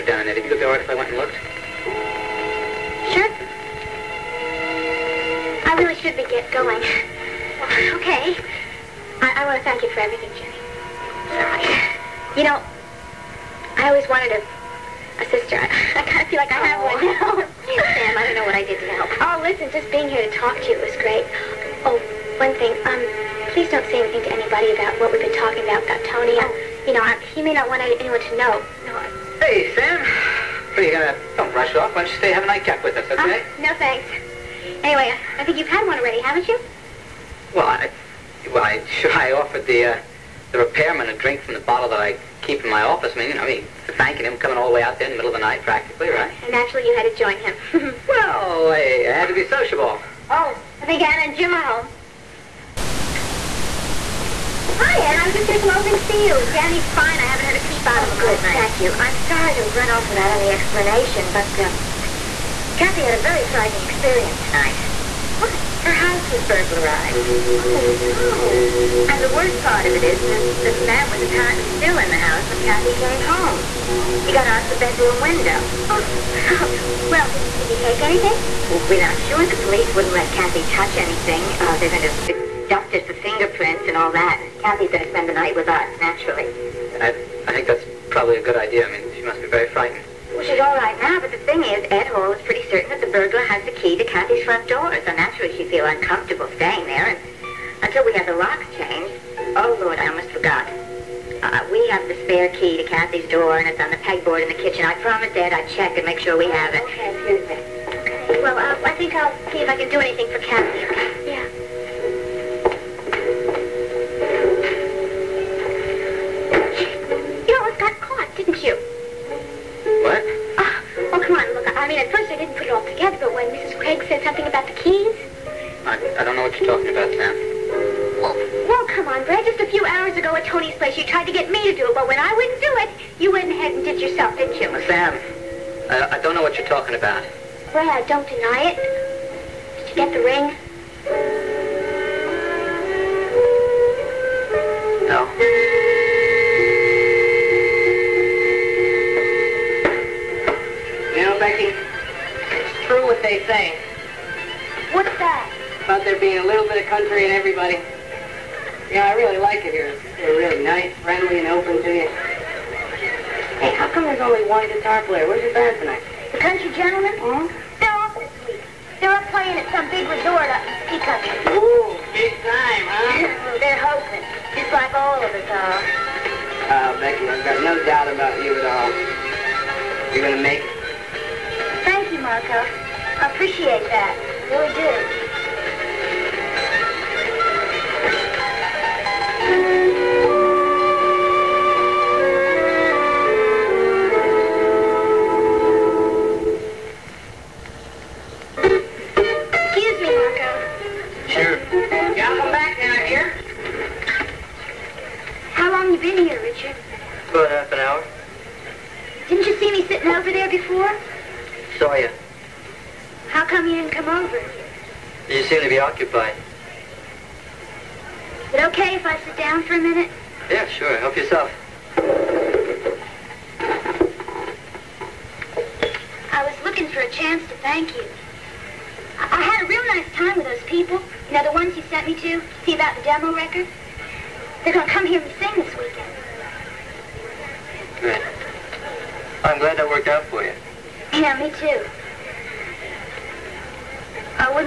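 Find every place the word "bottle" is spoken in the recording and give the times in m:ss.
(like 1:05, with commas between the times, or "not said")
0:41.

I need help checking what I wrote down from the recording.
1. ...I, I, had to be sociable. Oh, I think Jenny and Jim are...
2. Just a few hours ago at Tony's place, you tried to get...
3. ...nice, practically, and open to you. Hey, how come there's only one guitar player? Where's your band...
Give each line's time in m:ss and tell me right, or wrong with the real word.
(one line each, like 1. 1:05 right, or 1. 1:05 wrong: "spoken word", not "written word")
1. 0:48 wrong: "Anna", not "Jenny"
2. 2:09 right
3. 2:40 wrong: "friendly", not "practically".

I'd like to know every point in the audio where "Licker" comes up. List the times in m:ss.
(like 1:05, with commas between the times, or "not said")
not said.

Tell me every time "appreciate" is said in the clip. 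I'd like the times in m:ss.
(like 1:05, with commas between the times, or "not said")
3:03.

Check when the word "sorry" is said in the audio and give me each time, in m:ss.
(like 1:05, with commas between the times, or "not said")
0:11, 0:59.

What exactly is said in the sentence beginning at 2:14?
Well, Sam, I, I don't know what you're talking about.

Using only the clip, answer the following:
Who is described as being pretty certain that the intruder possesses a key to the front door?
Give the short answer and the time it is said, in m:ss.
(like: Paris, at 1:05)
Ed Hall, at 1:31.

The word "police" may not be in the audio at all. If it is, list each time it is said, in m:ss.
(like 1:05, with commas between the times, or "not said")
1:19.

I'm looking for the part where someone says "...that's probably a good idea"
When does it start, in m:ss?
1:27.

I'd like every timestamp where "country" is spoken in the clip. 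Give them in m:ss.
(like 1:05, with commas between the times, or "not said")
2:36, 2:46, 2:51.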